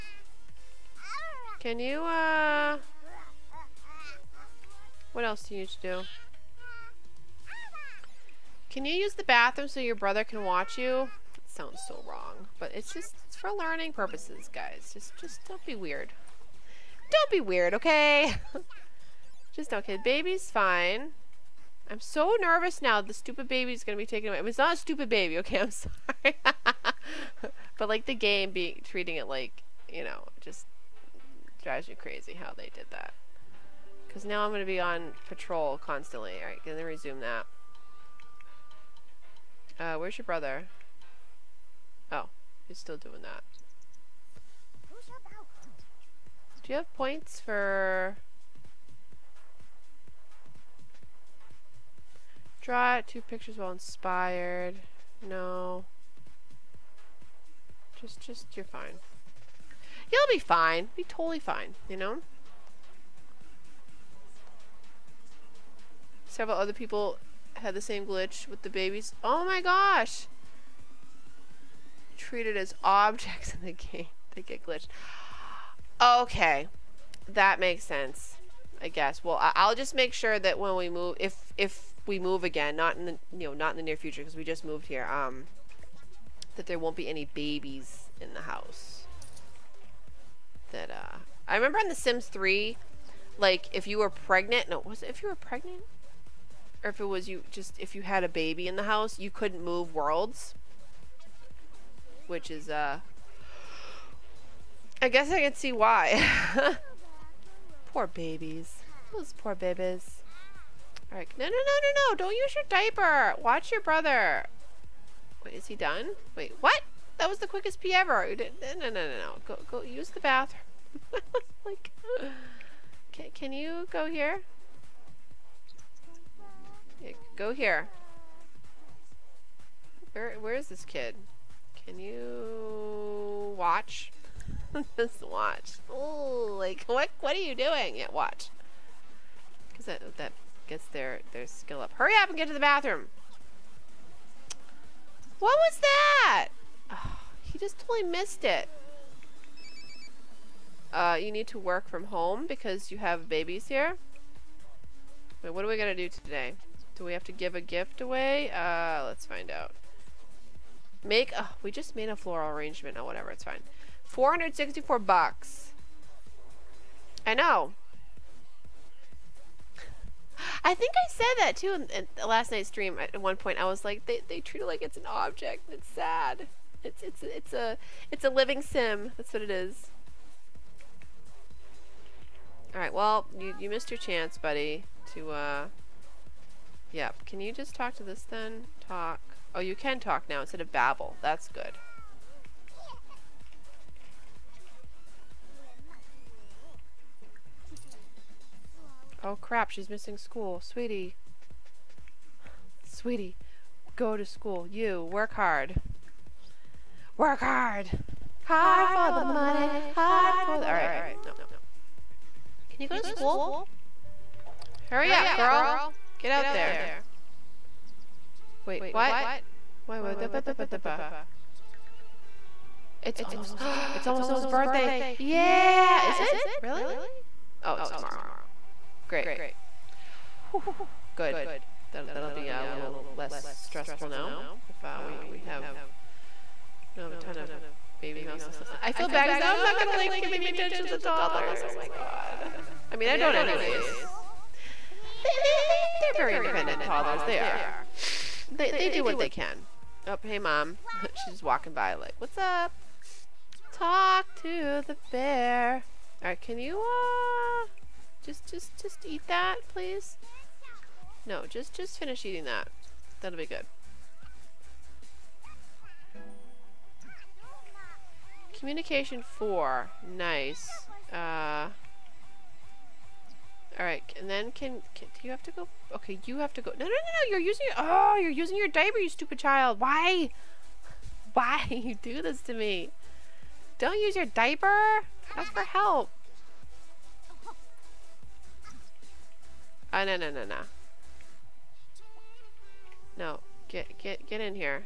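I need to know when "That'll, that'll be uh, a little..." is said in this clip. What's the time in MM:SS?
03:51.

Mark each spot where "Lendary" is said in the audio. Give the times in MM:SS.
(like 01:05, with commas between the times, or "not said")
not said.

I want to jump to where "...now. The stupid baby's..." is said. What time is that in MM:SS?
00:22.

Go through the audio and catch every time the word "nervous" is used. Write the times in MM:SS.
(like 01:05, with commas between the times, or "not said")
00:22.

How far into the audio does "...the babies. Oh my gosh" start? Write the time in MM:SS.
01:08.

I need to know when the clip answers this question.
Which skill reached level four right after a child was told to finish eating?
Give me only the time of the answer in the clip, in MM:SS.
04:28.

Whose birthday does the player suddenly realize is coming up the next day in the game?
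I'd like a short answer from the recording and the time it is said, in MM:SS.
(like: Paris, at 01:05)
Noah, at 03:44.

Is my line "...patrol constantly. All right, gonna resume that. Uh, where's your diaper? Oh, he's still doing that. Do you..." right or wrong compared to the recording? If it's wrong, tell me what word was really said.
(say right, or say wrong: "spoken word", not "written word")
wrong: "brother", not "diaper".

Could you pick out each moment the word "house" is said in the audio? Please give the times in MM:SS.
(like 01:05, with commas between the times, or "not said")
01:28, 01:38.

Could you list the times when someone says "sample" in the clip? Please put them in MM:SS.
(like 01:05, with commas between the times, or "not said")
not said.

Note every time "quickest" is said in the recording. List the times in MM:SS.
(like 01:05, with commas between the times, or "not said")
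01:57.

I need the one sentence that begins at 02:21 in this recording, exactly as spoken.
Hurry up and get to the bathroom.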